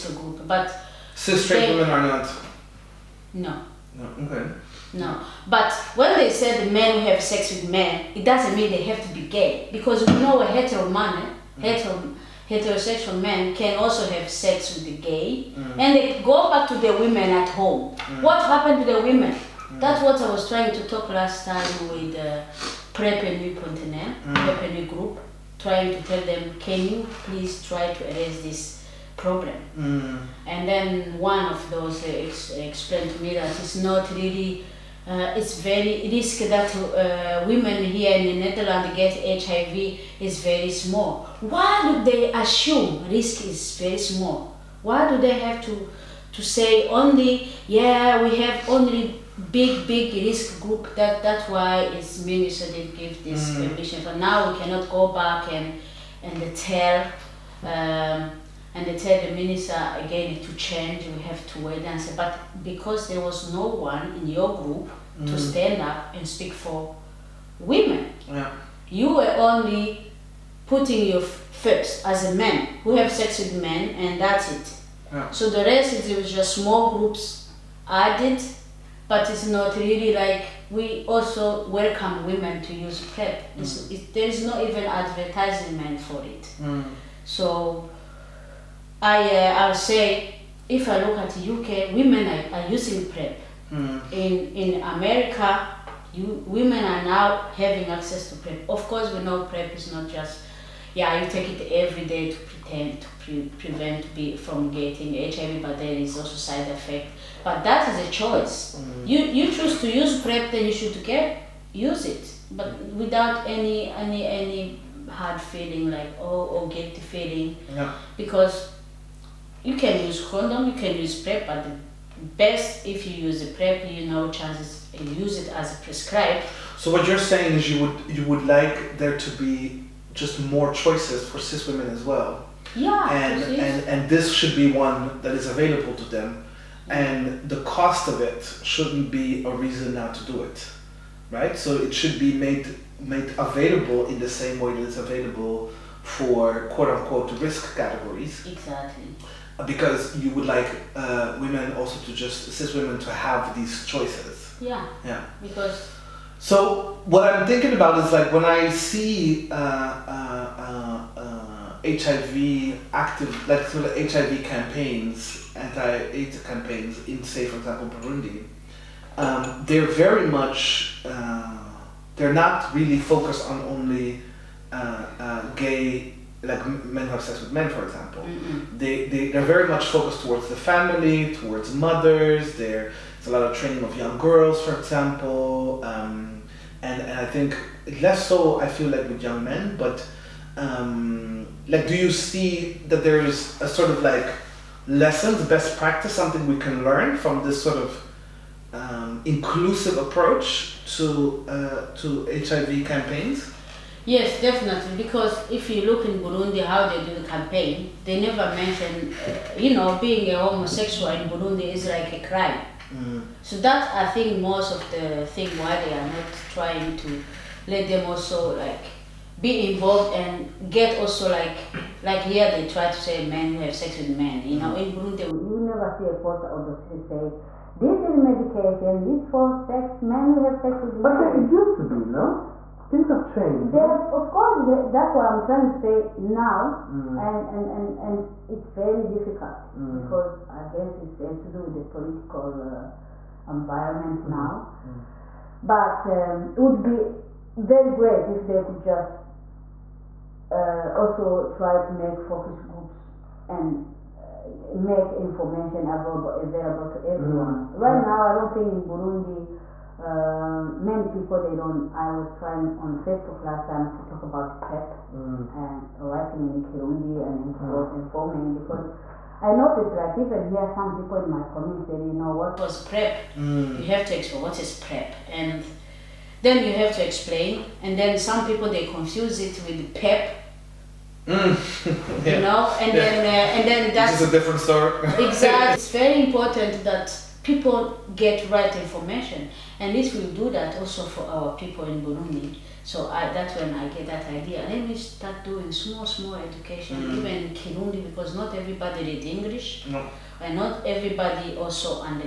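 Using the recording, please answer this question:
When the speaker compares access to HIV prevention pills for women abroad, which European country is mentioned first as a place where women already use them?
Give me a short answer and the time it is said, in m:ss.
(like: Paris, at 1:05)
UK, at 1:31.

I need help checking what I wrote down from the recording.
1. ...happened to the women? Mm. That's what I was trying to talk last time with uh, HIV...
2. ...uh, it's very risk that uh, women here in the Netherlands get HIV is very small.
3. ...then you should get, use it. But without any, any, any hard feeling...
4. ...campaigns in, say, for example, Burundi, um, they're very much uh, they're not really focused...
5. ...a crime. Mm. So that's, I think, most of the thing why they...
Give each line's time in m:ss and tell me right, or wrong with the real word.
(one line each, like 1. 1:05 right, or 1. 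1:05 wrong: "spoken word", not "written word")
1. 0:18 wrong: "PrEP", not "HIV"
2. 0:35 right
3. 1:50 right
4. 2:46 right
5. 3:32 right.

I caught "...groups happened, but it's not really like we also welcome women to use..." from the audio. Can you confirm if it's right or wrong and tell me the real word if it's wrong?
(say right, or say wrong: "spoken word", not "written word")
wrong: "added", not "happened".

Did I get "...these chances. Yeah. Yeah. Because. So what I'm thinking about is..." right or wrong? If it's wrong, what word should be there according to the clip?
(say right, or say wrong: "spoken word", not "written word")
wrong: "choices", not "chances".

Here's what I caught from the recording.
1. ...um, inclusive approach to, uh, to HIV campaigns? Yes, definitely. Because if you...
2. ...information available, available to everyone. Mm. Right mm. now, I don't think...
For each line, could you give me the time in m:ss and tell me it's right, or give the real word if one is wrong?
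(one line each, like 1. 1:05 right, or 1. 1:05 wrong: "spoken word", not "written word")
1. 3:18 right
2. 4:15 right.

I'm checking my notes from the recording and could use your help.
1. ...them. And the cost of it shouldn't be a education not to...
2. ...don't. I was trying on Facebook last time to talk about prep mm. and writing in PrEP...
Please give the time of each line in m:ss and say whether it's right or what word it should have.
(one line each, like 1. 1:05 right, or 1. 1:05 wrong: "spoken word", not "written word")
1. 2:16 wrong: "reason", not "education"
2. 4:21 wrong: "Kirundi", not "PrEP".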